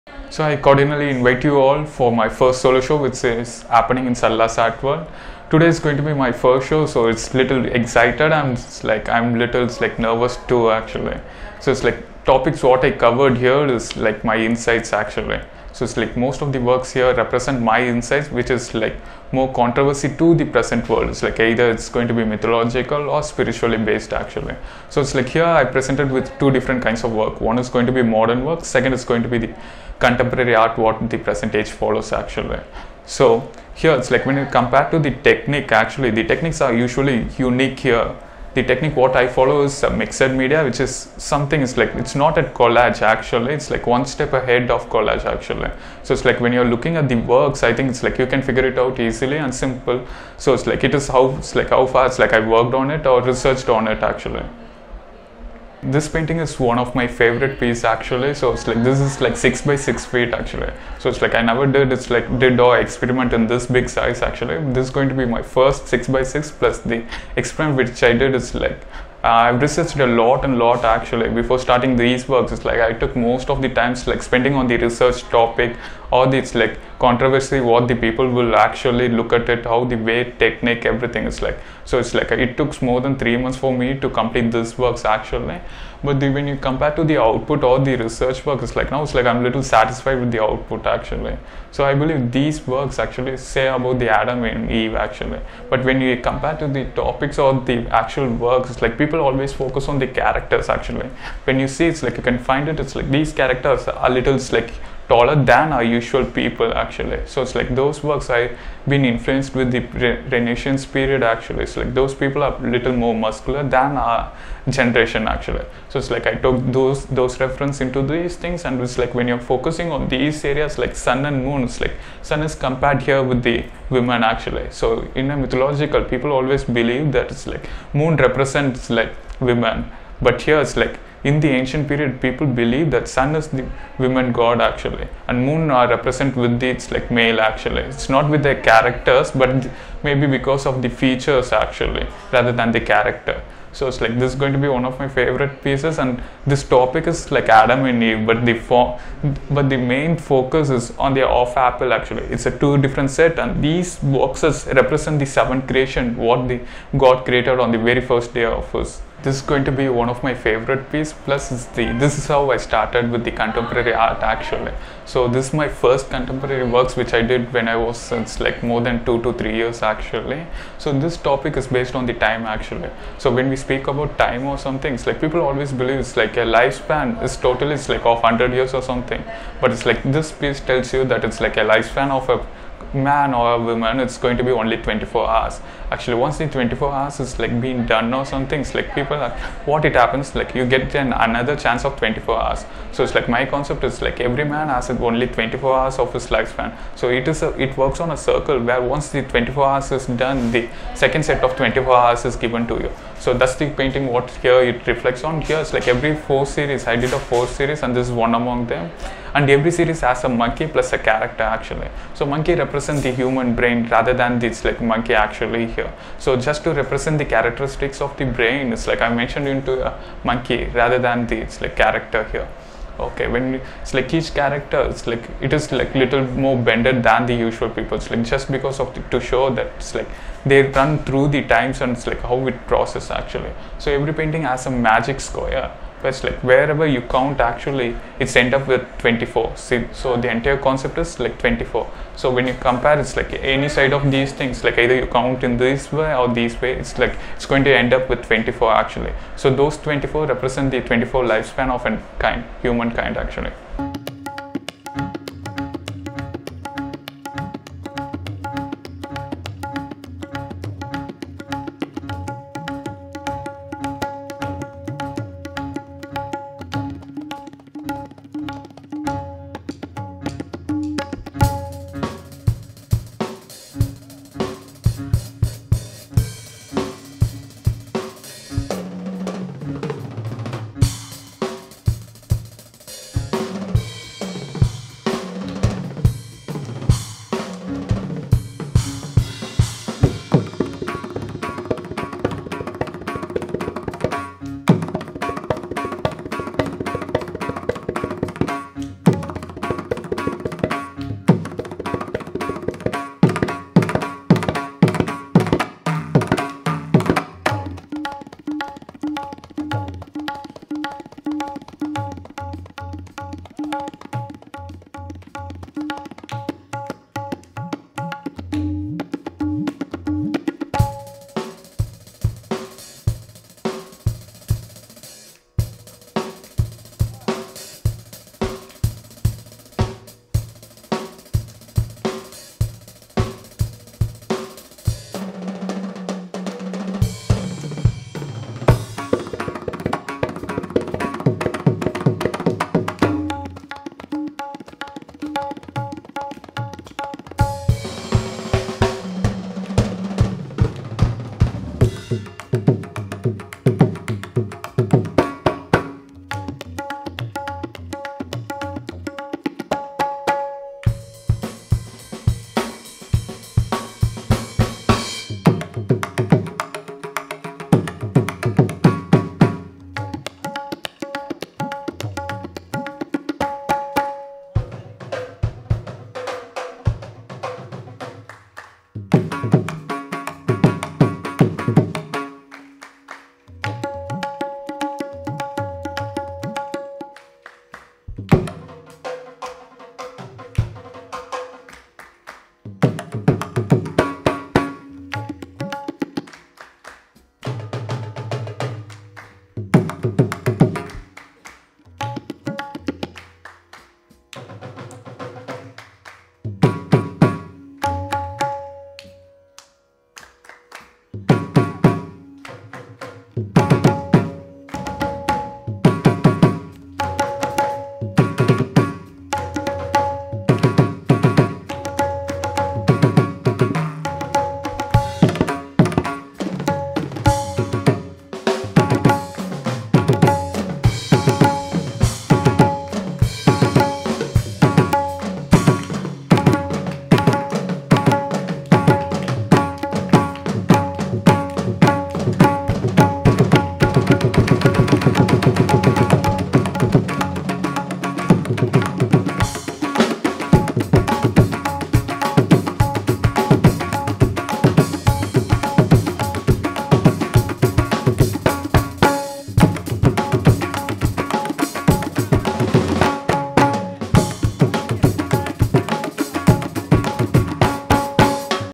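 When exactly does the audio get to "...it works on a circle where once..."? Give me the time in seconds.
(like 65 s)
197 s.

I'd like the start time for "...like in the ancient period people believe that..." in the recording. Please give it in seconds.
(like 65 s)
130 s.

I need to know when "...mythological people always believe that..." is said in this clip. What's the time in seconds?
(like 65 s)
125 s.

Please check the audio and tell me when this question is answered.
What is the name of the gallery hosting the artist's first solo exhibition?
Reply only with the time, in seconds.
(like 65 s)
4 s.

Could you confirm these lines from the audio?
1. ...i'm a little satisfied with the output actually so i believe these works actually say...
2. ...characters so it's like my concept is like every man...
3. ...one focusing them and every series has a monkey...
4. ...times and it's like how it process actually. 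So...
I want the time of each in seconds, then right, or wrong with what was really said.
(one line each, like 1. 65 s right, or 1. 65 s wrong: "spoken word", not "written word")
1. 89 s right
2. 192 s wrong: "hours", not "characters"
3. 208 s wrong: "among", not "focusing"
4. 231 s right.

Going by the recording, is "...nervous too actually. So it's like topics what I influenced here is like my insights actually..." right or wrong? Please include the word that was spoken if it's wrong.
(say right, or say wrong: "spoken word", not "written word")
wrong: "covered", not "influenced".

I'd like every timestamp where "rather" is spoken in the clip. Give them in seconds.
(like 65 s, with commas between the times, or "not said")
142 s, 213 s, 220 s.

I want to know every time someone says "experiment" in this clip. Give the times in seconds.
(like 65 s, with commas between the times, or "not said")
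62 s, 67 s.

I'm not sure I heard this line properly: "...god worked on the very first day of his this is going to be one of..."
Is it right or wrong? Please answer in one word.
wrong.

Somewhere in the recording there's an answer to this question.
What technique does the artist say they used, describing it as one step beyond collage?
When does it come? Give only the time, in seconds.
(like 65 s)
39 s.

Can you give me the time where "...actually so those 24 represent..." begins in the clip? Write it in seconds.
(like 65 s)
248 s.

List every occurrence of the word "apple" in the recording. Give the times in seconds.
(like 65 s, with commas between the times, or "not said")
151 s.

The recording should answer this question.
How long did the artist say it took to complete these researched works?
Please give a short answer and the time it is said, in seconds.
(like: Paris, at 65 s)
More than 3 months, at 82 s.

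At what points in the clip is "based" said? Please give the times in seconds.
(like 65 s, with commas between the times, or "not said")
23 s, 171 s.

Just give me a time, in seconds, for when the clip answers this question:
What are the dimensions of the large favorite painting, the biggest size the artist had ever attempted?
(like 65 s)
59 s.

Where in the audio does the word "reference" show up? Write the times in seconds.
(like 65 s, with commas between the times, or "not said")
117 s.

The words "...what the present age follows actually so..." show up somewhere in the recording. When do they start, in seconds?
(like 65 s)
30 s.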